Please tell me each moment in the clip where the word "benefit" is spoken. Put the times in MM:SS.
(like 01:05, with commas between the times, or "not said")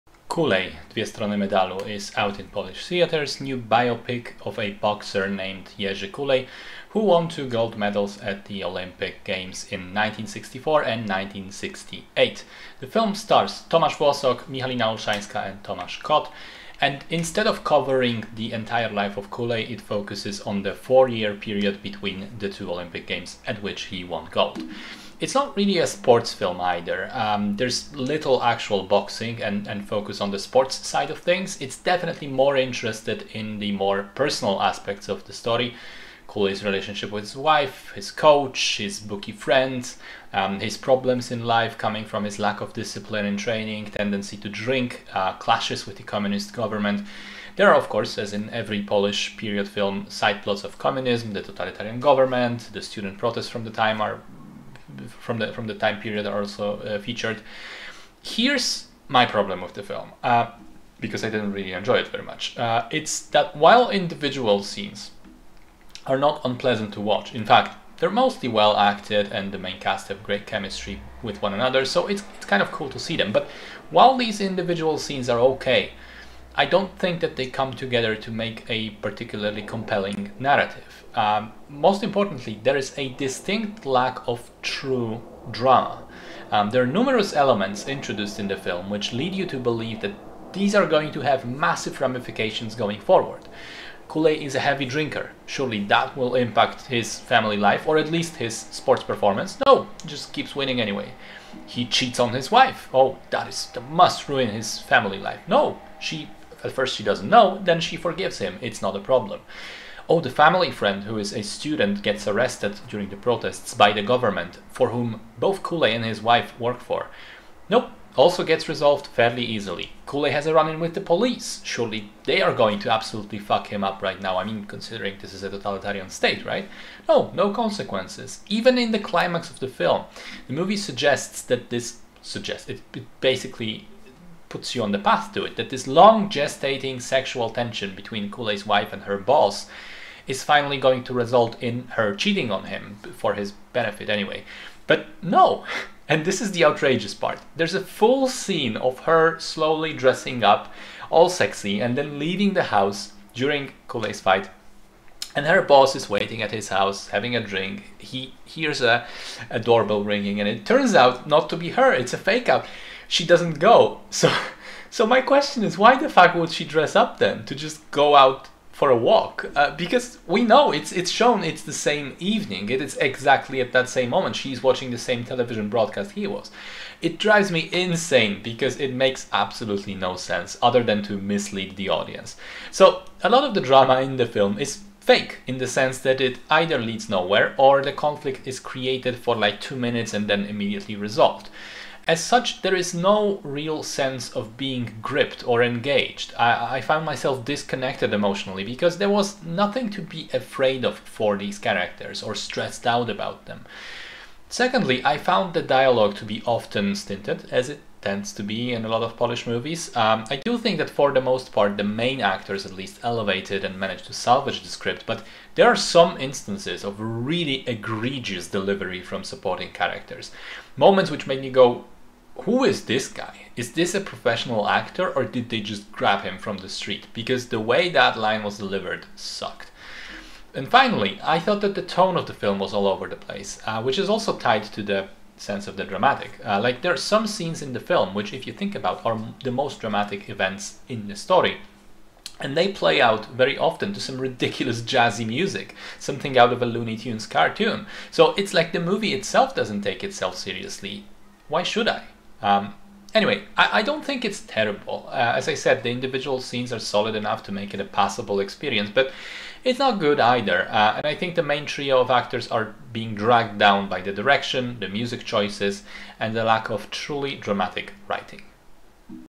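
02:23.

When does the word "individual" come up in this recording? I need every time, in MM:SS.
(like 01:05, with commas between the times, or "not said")
01:03, 01:14, 04:15.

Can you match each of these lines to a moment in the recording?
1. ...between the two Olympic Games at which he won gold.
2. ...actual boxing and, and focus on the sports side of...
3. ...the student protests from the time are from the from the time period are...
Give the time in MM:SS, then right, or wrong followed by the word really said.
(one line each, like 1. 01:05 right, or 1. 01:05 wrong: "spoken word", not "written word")
1. 00:21 right
2. 00:28 right
3. 00:52 right.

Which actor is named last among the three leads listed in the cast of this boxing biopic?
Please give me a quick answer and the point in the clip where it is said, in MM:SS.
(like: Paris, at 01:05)
Tomasz Kot, at 00:15.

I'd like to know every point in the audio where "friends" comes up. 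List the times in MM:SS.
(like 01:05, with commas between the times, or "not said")
00:39, 01:50.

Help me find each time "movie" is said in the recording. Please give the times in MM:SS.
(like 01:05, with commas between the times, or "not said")
02:10, 03:29, 04:08.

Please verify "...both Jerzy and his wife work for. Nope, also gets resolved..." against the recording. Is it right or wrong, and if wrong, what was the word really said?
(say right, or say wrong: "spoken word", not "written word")
wrong: "Kulej", not "Jerzy".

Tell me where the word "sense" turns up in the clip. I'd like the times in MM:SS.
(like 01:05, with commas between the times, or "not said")
03:00, 03:05, 03:13, 03:55.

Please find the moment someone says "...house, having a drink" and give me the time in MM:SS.
02:36.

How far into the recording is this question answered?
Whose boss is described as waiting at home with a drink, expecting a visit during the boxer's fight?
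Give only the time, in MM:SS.
02:18.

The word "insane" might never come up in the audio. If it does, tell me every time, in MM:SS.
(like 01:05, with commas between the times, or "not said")
02:57.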